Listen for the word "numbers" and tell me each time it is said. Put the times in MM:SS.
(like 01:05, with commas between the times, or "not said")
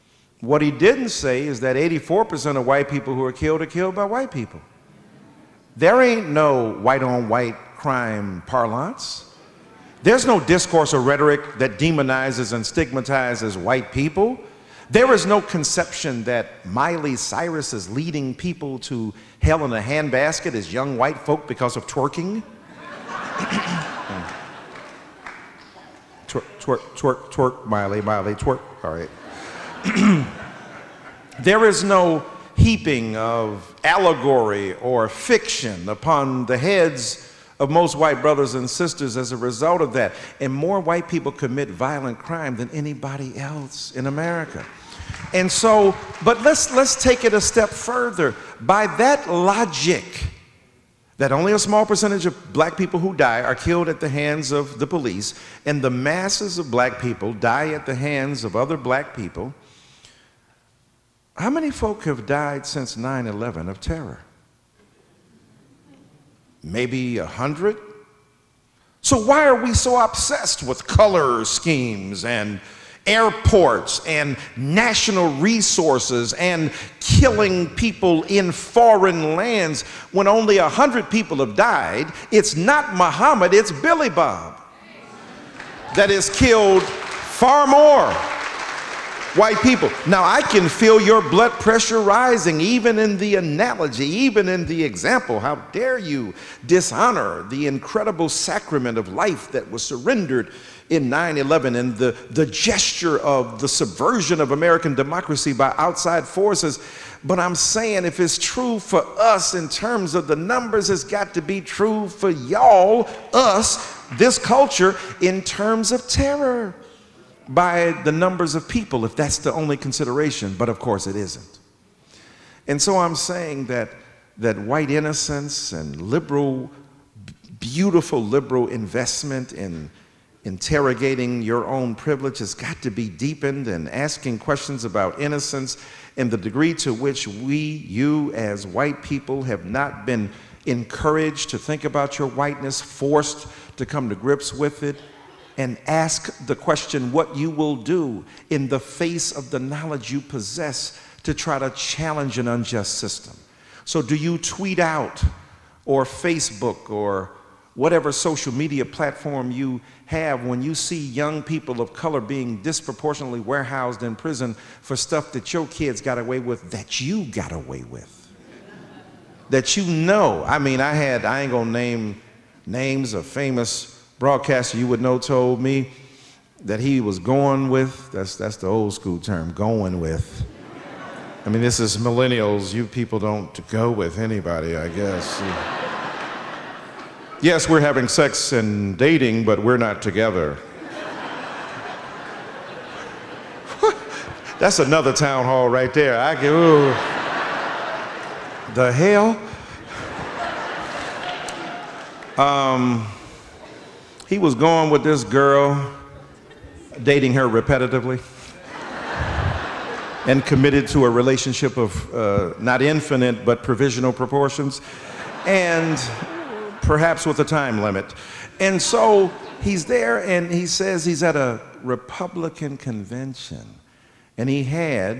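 01:50, 01:58.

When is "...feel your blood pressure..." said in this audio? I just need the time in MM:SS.
01:30.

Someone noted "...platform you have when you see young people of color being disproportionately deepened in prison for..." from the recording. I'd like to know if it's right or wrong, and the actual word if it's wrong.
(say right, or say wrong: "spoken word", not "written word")
wrong: "warehoused", not "deepened".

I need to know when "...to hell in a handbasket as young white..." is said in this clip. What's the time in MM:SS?
00:18.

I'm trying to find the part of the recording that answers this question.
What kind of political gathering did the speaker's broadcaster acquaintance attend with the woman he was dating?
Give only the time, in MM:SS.
03:41.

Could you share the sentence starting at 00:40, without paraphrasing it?
And more white people commit violent crime than anybody else in America.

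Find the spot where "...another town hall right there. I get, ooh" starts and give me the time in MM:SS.
03:14.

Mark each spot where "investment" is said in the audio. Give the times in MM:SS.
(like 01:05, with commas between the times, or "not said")
02:08.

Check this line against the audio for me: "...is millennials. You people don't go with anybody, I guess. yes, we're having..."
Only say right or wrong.
right.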